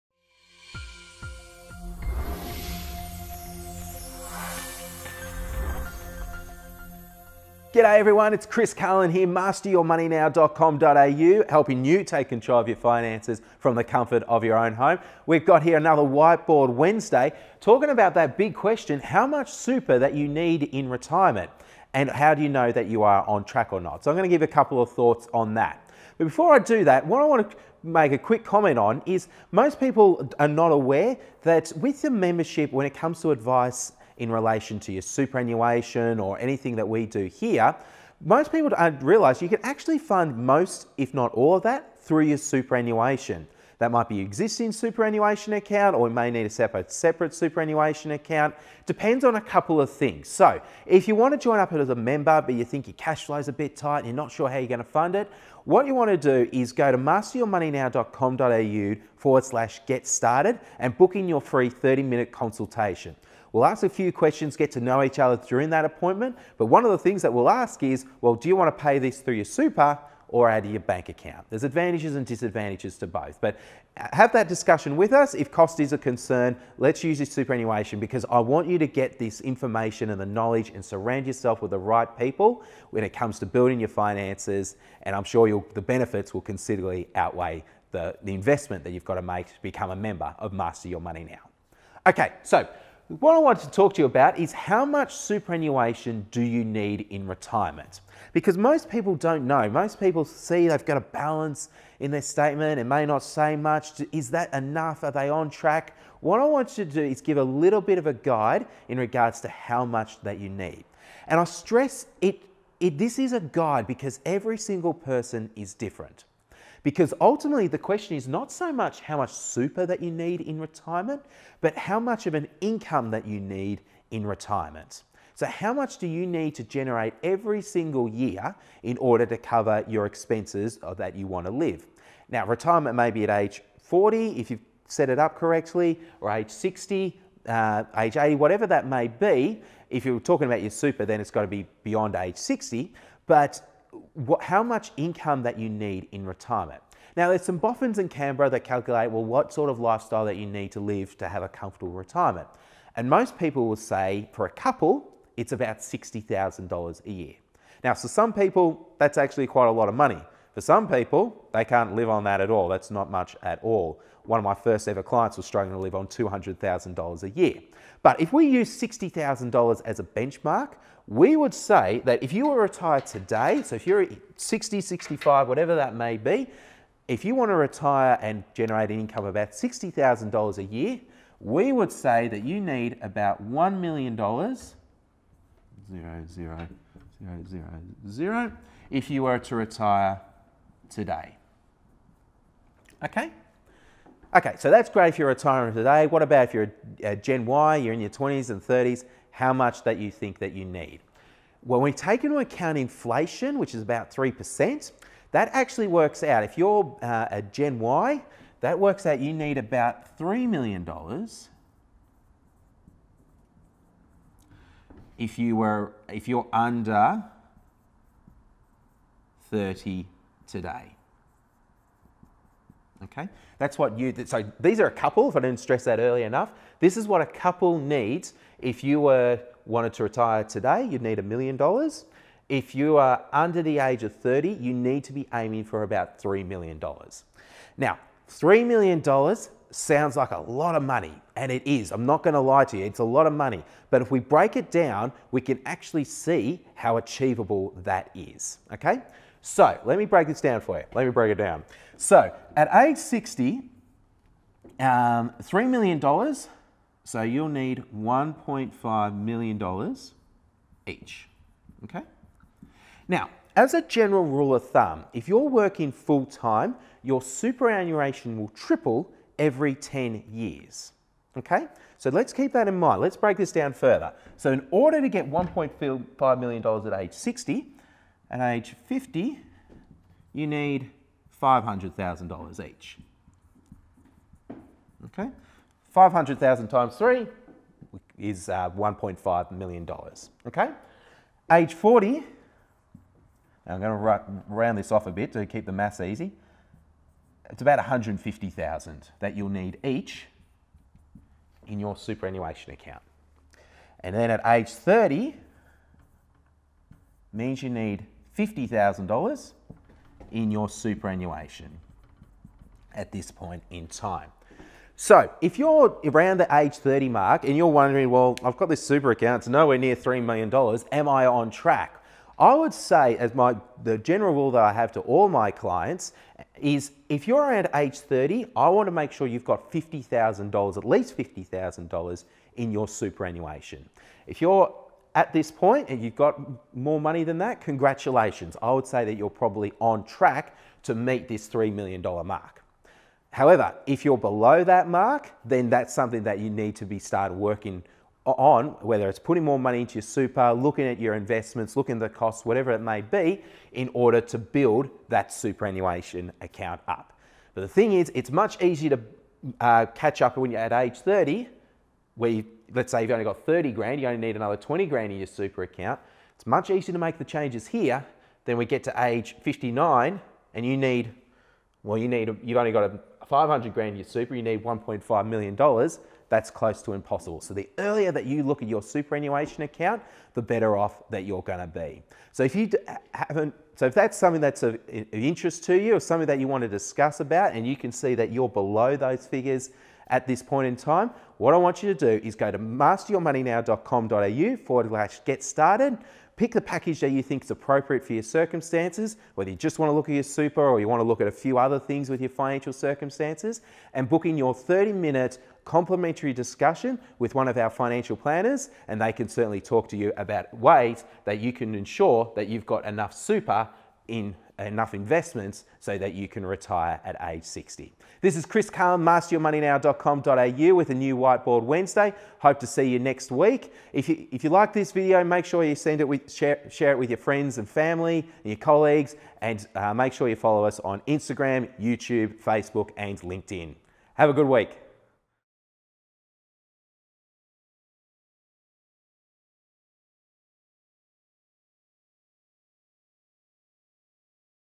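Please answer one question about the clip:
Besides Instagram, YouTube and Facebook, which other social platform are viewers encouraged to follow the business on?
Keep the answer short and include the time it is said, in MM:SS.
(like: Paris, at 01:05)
LinkedIn, at 07:13.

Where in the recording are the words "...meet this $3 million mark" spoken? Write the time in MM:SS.
05:40.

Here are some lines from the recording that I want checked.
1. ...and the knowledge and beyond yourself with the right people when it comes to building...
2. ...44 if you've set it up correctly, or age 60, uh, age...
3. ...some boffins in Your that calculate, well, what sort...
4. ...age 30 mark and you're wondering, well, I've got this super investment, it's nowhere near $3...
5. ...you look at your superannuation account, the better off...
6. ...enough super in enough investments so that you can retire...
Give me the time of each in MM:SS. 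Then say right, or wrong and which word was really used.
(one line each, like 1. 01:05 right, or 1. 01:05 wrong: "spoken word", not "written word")
1. 01:20 wrong: "surround", not "beyond"
2. 02:13 wrong: "40", not "44"
3. 02:27 wrong: "Canberra", not "Your"
4. 05:16 wrong: "account", not "investment"
5. 06:18 right
6. 06:52 right.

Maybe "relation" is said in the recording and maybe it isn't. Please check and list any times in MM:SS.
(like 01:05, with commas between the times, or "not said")
00:34.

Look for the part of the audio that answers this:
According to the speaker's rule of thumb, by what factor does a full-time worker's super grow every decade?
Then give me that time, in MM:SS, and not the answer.
04:28.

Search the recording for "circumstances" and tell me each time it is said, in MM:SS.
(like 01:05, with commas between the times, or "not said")
06:38, 06:42.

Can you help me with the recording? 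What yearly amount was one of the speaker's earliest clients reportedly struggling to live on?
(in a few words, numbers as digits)
$200,000.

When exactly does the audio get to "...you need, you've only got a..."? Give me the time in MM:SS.
06:11.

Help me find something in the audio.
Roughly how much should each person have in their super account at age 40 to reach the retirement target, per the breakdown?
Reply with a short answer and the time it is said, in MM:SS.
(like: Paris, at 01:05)
150,000, at 04:57.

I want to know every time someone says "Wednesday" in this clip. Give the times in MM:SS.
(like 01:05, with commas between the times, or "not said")
00:16, 07:01.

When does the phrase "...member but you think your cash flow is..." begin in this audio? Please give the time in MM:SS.
00:51.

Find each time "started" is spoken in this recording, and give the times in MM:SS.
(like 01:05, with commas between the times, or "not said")
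01:00, 05:46, 06:35.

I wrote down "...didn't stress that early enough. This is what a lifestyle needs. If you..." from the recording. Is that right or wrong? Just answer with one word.
wrong.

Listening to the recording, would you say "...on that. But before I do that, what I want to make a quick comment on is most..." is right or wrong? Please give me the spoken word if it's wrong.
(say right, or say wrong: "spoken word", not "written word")
right.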